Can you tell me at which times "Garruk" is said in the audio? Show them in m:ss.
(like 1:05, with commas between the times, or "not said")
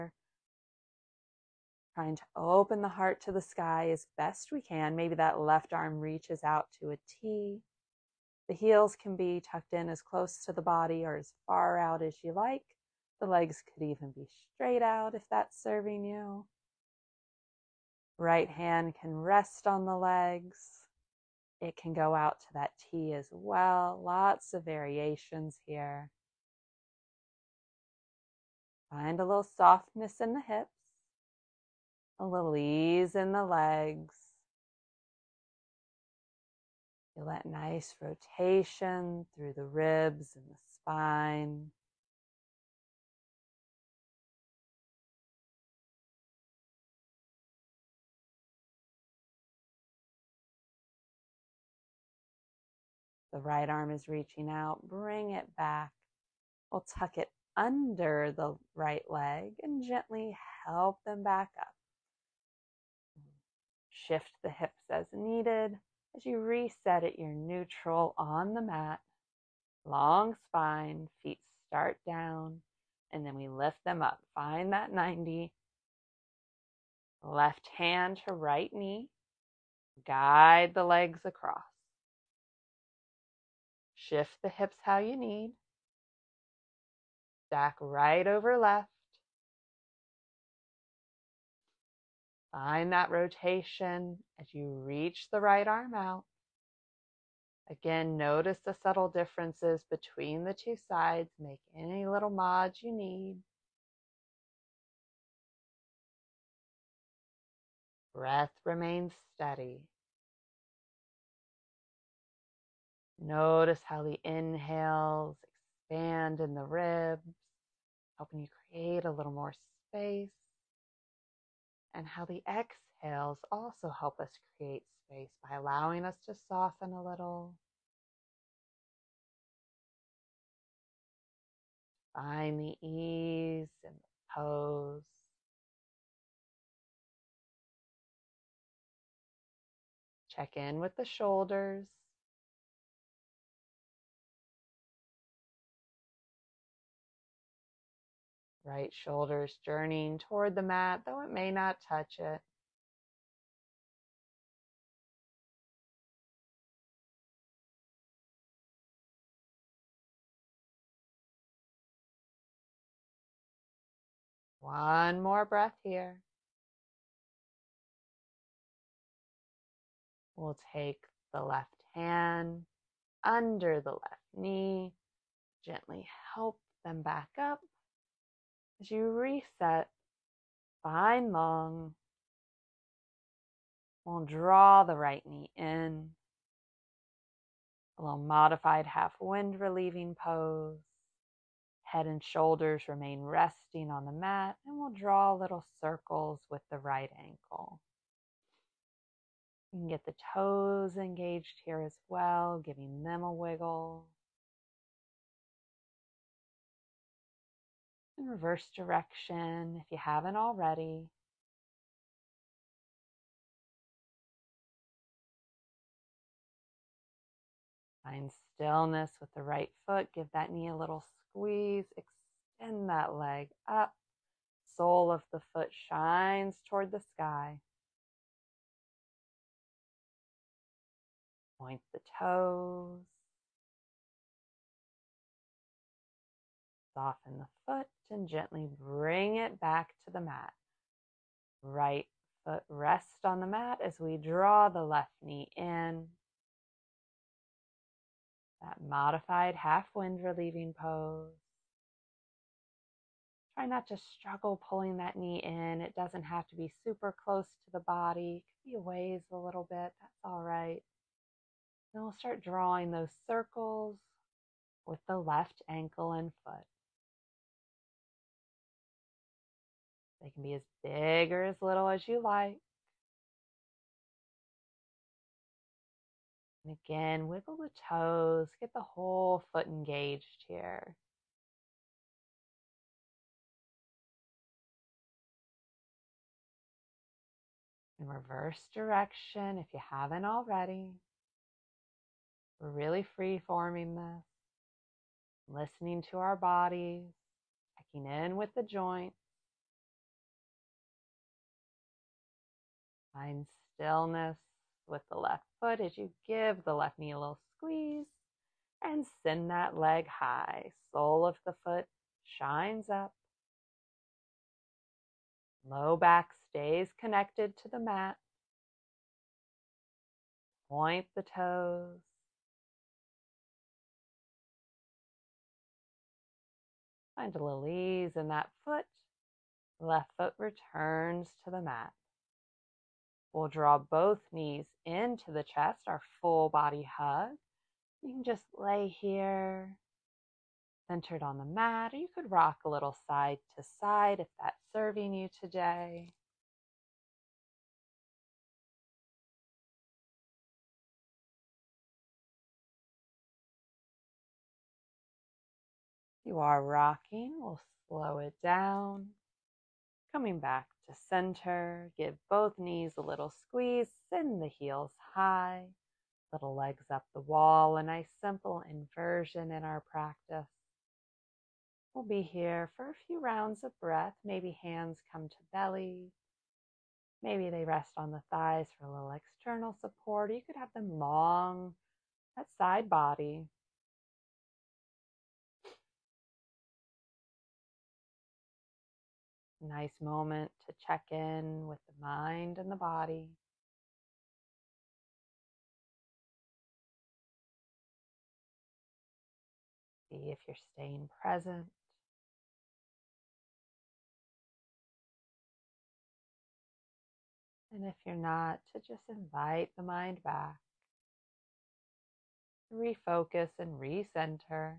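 not said.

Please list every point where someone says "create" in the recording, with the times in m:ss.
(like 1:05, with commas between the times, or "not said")
1:58, 2:04.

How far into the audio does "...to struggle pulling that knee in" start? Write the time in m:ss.
4:13.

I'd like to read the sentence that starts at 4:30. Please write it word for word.
They can be as big or as little as you like.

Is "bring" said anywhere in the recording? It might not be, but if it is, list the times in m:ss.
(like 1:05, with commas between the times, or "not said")
0:54, 3:58.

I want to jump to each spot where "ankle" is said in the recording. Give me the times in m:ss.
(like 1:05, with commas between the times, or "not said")
3:17, 4:25.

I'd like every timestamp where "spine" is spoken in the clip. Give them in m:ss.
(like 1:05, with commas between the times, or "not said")
0:40, 1:10.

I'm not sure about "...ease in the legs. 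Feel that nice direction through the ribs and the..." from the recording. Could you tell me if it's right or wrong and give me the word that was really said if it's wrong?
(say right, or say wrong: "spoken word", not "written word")
wrong: "rotation", not "direction".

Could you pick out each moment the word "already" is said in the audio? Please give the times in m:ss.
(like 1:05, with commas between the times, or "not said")
3:30, 4:50.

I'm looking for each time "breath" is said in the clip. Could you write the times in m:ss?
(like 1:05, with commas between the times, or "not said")
1:48, 2:45, 6:13.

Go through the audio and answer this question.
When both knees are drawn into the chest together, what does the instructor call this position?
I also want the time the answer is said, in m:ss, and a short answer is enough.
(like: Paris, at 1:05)
Full body hug, at 5:36.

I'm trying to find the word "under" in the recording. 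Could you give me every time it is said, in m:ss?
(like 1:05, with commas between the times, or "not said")
0:57, 2:53.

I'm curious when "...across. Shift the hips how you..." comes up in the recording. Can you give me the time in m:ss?
1:21.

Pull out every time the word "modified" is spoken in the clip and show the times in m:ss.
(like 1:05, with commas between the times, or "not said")
3:08, 4:08.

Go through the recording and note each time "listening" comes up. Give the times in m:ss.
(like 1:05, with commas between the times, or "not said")
4:55.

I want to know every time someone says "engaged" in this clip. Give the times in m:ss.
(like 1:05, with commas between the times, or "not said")
3:20, 4:39.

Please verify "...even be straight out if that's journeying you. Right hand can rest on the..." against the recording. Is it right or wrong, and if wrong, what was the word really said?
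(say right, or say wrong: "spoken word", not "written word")
wrong: "serving", not "journeying".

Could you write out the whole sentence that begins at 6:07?
A nice simple inversion in our practice.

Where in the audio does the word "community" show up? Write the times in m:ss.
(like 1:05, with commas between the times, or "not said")
not said.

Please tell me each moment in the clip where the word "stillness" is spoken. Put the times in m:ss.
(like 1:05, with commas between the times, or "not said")
3:38, 5:03.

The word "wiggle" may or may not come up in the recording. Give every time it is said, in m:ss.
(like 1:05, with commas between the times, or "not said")
3:23, 4:37.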